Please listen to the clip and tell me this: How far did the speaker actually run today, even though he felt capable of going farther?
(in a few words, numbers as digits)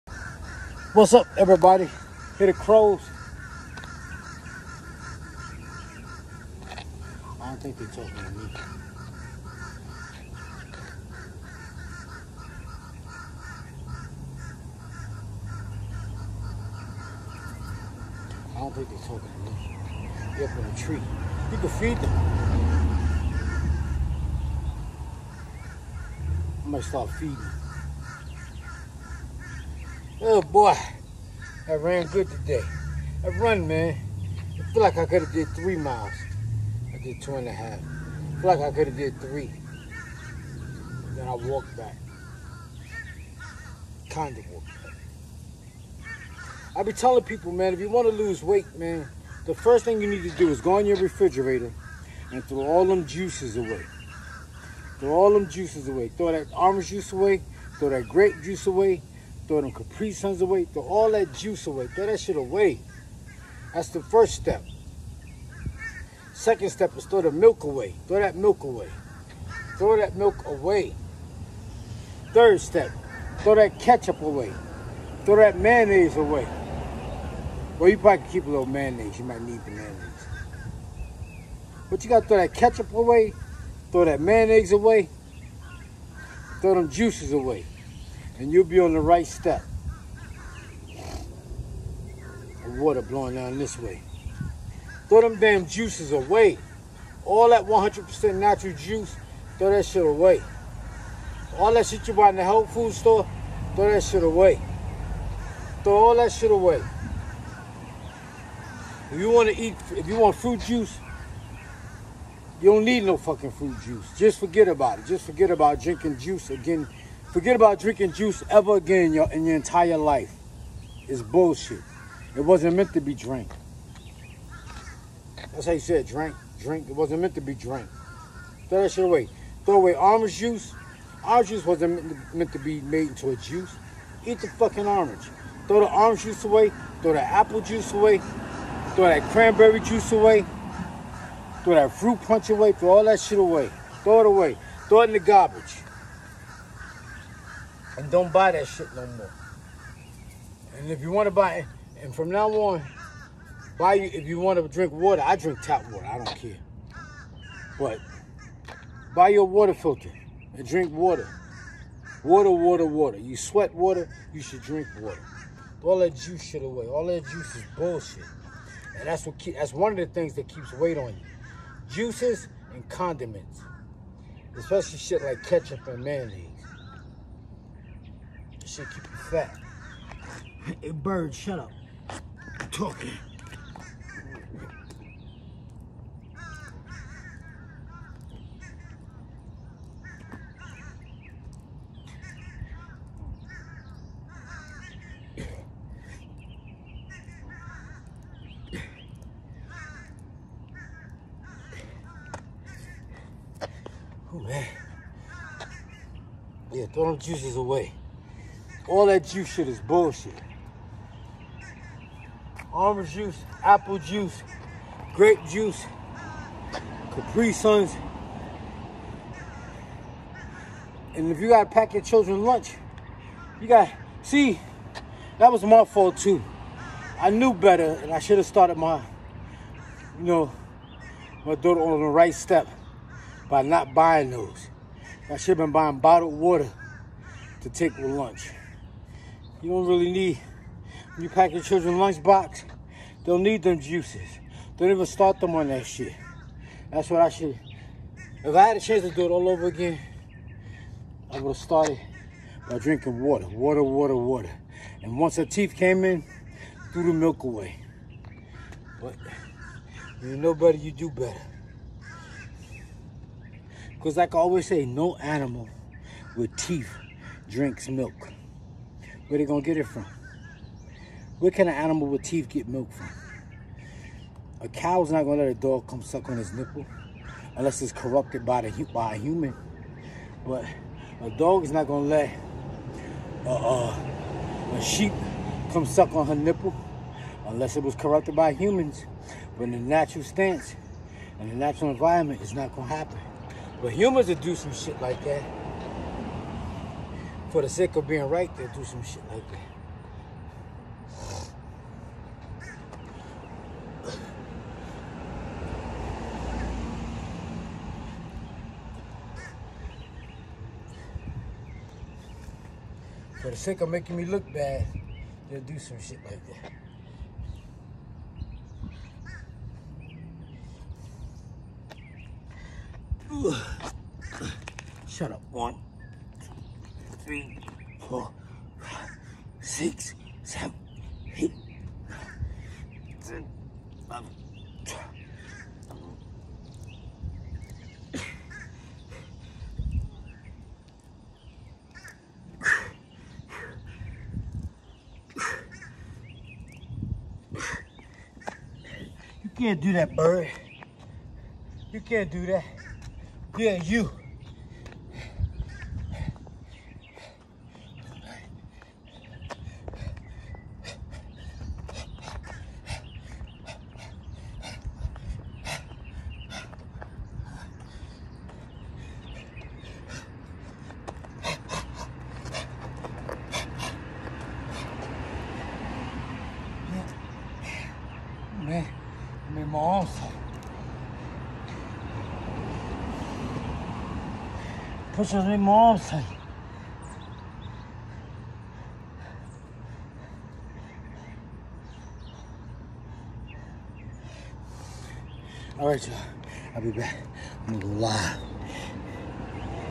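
2.5 miles.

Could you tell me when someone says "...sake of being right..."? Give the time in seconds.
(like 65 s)
297 s.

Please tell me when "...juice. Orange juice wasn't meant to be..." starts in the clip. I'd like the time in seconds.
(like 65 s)
130 s.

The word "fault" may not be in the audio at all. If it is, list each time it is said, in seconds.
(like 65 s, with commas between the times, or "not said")
225 s.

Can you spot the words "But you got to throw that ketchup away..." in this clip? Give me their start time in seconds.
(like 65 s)
81 s.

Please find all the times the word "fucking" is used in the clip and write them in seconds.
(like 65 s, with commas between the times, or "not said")
113 s, 134 s.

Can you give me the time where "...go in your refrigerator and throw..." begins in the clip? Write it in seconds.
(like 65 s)
50 s.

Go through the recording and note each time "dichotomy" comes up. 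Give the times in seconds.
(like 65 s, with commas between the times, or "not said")
not said.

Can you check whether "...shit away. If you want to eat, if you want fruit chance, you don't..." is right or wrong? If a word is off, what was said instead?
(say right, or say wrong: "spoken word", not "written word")
wrong: "juice", not "chance".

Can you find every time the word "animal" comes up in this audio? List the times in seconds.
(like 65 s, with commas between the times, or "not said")
265 s, 271 s.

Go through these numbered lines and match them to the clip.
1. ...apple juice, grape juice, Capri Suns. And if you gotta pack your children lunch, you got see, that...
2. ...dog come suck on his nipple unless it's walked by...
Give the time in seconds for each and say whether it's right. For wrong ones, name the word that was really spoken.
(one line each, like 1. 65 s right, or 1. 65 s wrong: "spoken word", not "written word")
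1. 213 s right
2. 275 s wrong: "corrupted", not "walked".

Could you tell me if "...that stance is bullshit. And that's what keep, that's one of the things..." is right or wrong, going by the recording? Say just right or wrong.
wrong.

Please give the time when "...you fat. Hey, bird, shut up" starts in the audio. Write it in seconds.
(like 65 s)
179 s.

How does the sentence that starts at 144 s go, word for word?
Throw it in the garbage and don't buy that shit no more.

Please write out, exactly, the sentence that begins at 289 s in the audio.
But in the natural stance and the natural environment, it's not gonna happen.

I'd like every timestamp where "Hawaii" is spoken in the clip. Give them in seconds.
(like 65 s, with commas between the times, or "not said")
not said.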